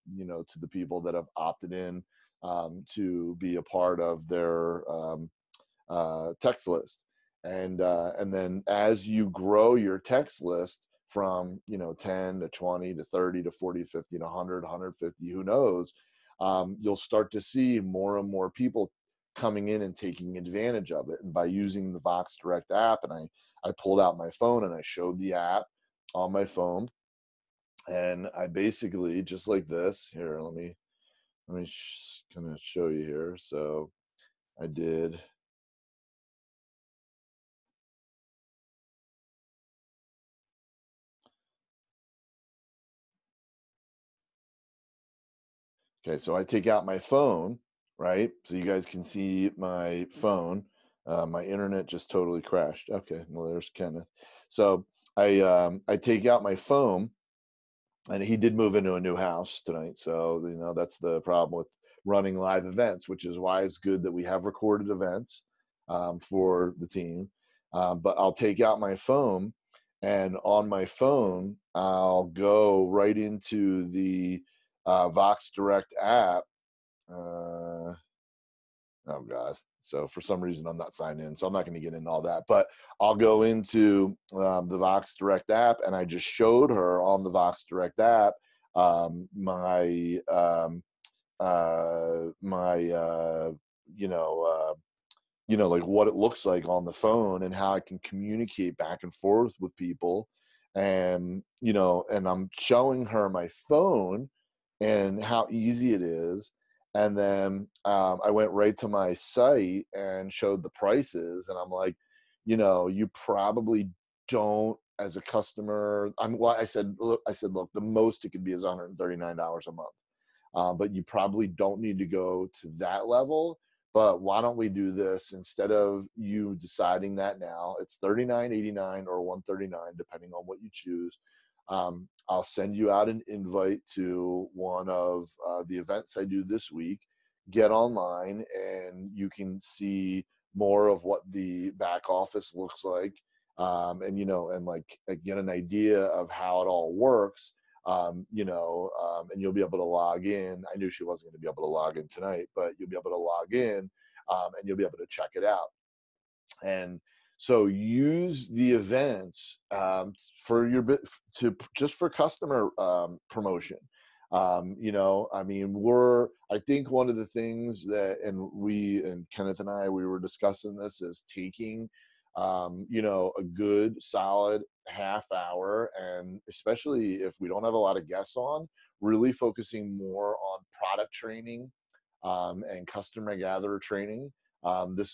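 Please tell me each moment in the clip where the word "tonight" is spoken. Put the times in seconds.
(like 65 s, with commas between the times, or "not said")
59 s, 152 s.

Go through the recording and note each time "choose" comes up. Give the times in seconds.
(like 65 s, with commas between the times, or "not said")
130 s.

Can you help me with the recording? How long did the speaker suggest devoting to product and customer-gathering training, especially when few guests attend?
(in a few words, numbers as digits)
half hour.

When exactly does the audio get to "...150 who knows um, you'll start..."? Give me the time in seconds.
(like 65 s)
14 s.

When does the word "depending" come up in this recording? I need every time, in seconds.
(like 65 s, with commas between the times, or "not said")
129 s.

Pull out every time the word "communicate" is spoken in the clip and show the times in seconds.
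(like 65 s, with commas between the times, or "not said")
98 s.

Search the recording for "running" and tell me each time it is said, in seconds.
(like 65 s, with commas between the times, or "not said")
62 s.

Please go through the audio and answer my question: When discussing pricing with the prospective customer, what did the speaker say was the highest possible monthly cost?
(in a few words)
$139.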